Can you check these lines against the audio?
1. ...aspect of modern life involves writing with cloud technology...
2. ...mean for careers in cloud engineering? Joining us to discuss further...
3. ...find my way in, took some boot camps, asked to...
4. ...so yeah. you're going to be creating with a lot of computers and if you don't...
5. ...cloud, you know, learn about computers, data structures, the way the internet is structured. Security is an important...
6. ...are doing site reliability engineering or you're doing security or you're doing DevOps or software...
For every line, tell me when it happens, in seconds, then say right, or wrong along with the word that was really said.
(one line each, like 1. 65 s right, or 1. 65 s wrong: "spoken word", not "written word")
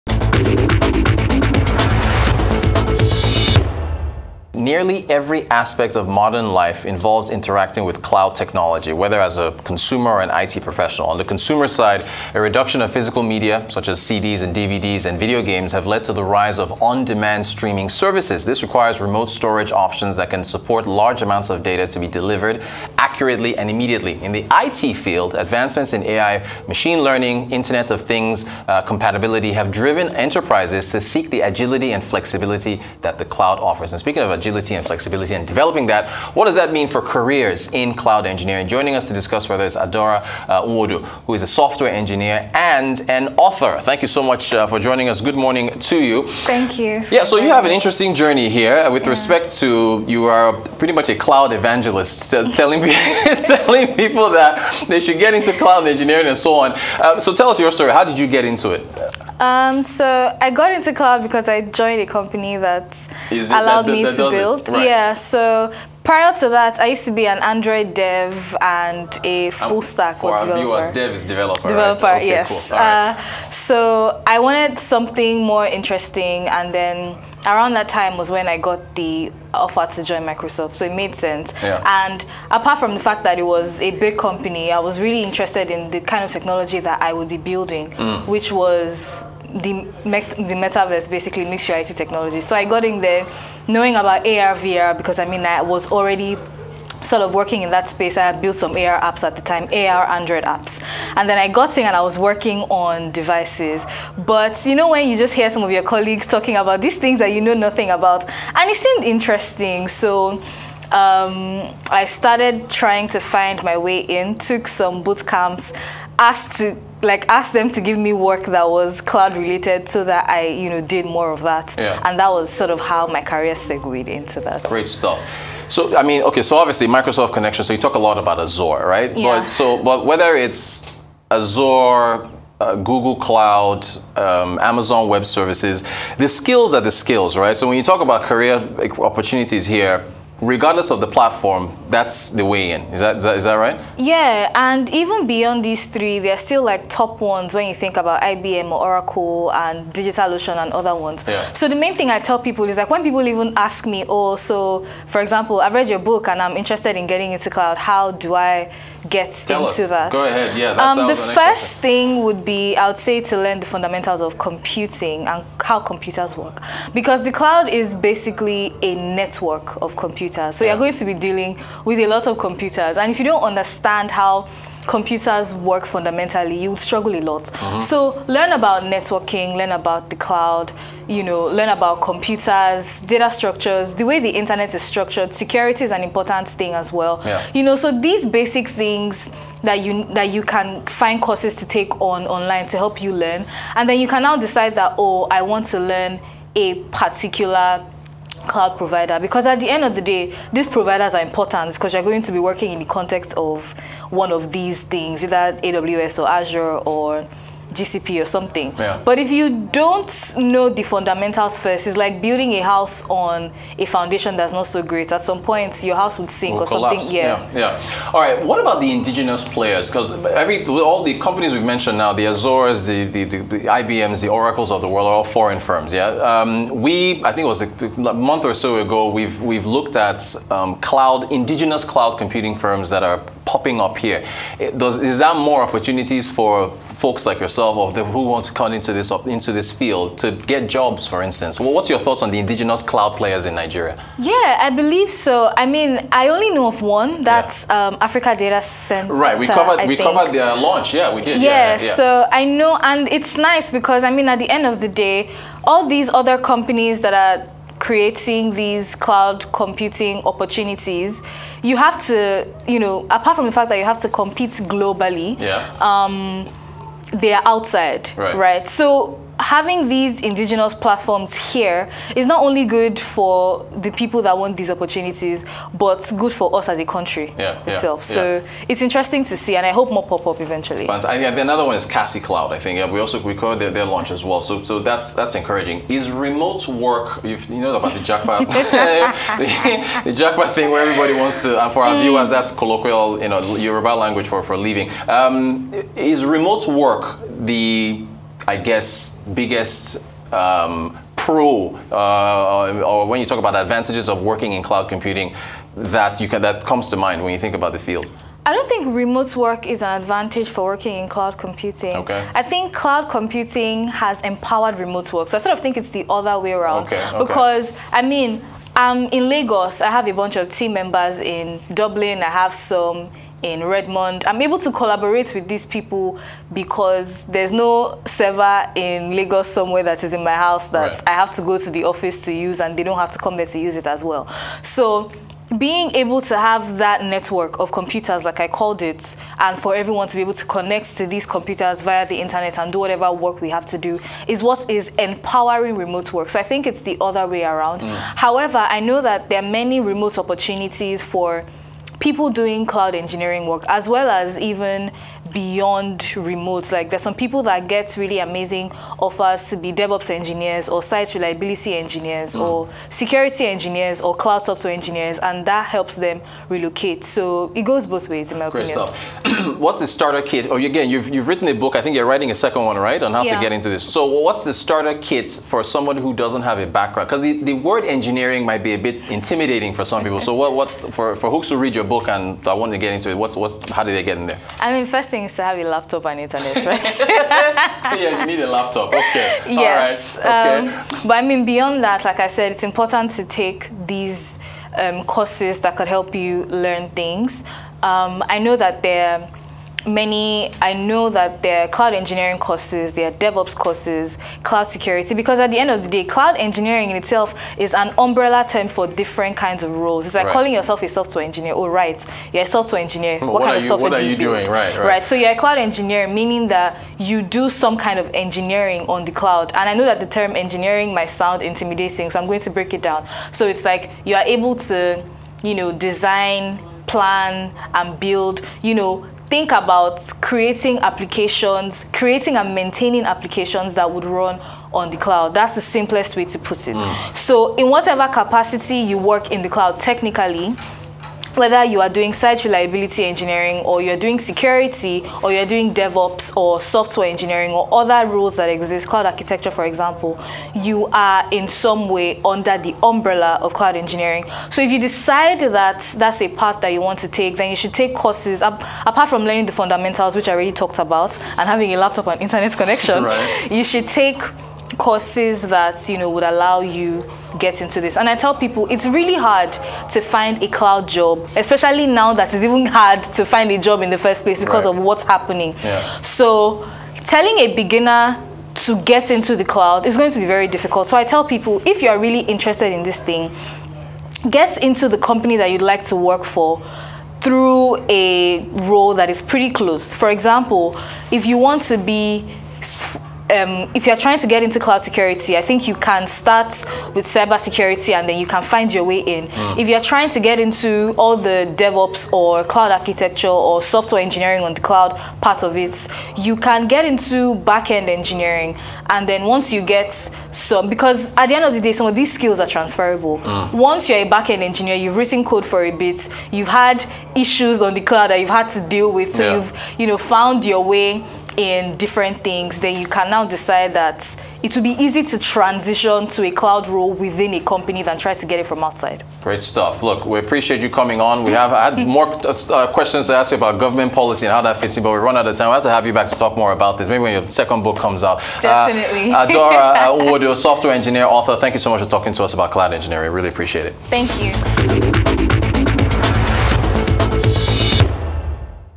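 1. 5 s wrong: "interacting", not "writing"
2. 36 s right
3. 113 s right
4. 170 s wrong: "dealing", not "creating"
5. 180 s right
6. 441 s right.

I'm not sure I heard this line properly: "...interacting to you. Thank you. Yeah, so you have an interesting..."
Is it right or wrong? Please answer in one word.
wrong.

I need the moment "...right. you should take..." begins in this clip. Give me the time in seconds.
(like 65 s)
463 s.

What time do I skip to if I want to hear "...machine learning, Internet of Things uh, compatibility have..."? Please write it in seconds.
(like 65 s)
26 s.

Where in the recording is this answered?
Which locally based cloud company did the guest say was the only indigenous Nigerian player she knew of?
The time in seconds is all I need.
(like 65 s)
247 s.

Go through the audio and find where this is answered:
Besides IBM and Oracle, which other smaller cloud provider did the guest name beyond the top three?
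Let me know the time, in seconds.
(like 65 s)
149 s.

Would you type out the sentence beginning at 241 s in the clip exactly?
Well, what's your thoughts on the indigenous cloud players in Nigeria?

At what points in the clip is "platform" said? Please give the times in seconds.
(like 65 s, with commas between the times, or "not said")
141 s, 270 s.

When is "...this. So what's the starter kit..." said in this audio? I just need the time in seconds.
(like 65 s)
373 s.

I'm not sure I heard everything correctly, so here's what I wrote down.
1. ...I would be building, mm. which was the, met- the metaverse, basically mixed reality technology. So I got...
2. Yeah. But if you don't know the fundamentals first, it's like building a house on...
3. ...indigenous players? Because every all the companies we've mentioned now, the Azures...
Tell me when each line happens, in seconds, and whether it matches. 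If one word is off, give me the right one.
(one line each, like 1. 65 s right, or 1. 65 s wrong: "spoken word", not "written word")
1. 87 s right
2. 208 s right
3. 218 s right.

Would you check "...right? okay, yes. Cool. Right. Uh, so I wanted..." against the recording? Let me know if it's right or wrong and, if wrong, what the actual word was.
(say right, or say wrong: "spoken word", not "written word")
right.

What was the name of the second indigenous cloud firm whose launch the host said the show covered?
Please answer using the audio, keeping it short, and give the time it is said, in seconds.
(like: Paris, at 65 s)
Kasi Cloud, at 281 s.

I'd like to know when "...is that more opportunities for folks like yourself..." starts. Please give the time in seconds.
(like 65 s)
235 s.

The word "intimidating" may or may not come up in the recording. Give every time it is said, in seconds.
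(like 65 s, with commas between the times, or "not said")
379 s, 421 s.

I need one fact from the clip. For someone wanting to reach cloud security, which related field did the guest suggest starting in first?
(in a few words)
cyber security.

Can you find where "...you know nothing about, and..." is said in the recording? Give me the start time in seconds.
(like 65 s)
107 s.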